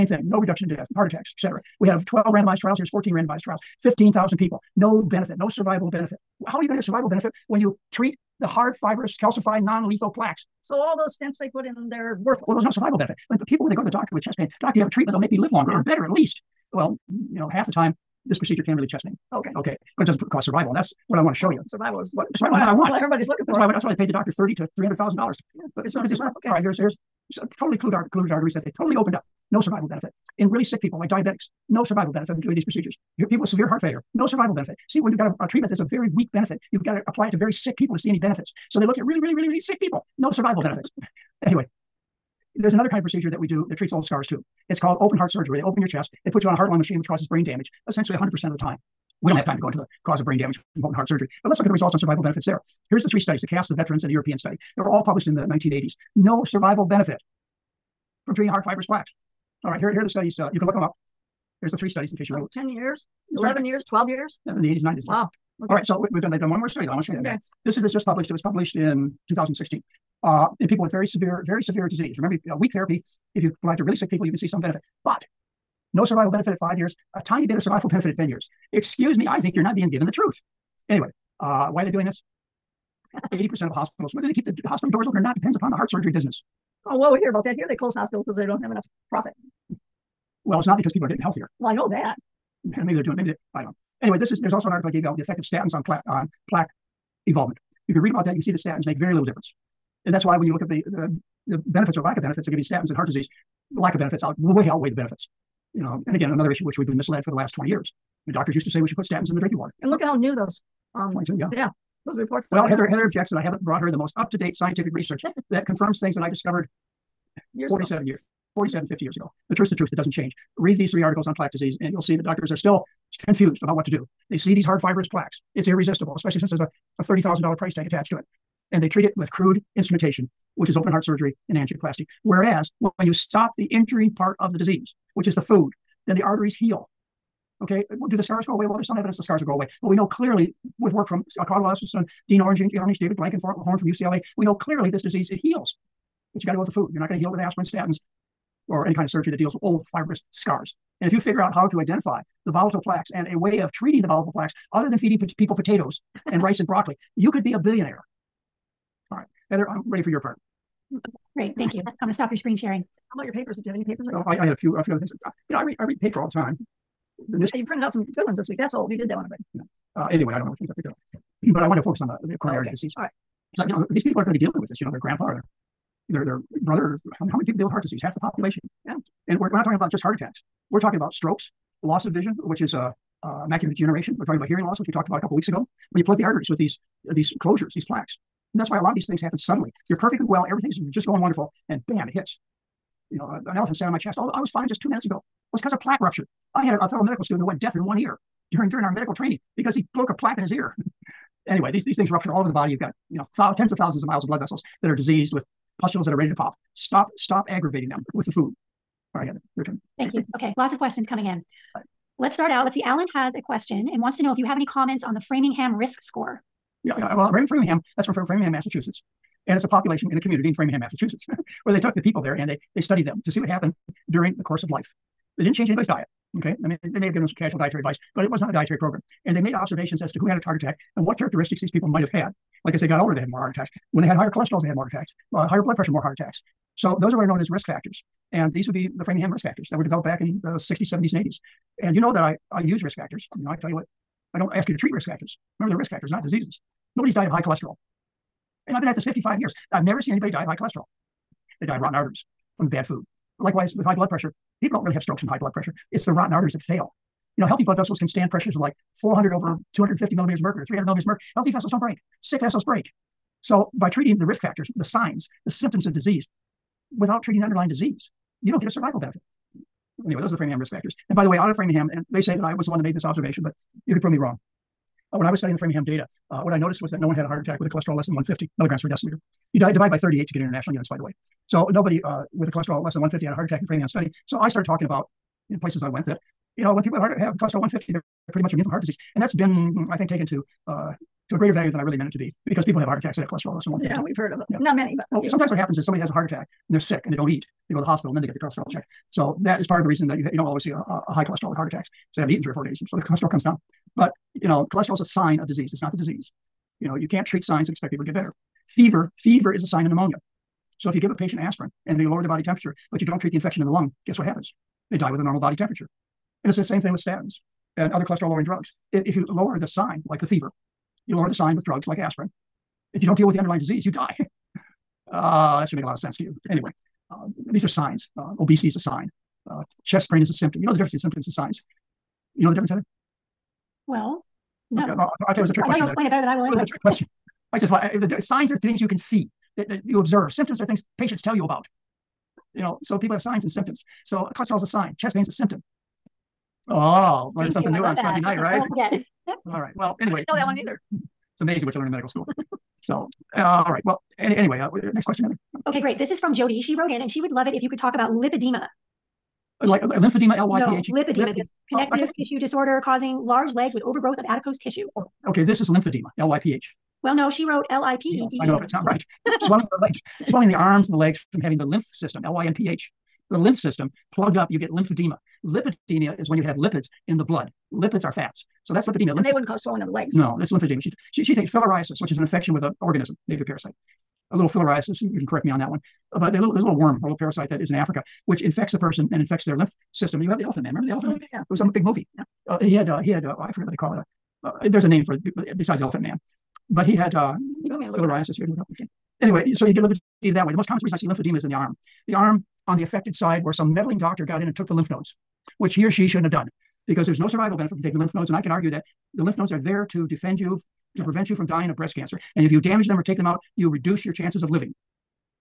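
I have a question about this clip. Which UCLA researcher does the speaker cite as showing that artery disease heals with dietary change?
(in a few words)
David Blankenhorn.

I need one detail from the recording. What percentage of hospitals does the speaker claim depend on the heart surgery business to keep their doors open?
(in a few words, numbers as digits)
80%.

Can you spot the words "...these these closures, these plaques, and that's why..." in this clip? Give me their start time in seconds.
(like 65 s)
186 s.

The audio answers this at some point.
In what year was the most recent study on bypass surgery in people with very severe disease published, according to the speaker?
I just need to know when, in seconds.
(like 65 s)
69 s.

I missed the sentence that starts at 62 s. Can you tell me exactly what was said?
10 years, 11 years, 12 years.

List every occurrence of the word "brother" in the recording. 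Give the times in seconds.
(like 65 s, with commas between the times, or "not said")
176 s.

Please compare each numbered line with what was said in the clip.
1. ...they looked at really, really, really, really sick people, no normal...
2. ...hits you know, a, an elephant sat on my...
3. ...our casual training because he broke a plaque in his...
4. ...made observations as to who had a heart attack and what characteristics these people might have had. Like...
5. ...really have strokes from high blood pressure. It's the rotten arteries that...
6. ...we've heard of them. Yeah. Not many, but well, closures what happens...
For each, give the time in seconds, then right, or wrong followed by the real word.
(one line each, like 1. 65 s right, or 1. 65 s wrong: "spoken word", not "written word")
1. 38 s wrong: "survival", not "normal"
2. 192 s right
3. 198 s wrong: "medical", not "casual"
4. 229 s right
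5. 254 s right
6. 294 s wrong: "sometimes", not "closures".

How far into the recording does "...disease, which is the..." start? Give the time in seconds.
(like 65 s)
134 s.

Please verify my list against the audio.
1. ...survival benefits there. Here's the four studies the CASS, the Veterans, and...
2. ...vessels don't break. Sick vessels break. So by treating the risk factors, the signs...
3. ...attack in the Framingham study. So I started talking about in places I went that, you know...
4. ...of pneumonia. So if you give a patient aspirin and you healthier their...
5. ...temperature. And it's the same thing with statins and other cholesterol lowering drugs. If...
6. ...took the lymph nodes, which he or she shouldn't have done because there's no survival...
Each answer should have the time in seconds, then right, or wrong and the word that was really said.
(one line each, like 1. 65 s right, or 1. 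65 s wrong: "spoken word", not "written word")
1. 51 s wrong: "three", not "four"
2. 261 s right
3. 283 s right
4. 309 s wrong: "lower", not "healthier"
5. 315 s right
6. 404 s right.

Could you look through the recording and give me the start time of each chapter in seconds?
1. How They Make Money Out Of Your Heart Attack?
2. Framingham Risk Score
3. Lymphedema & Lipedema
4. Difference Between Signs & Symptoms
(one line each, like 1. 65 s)
1. 66 s
2. 204 s
3. 355 s
4. 326 s.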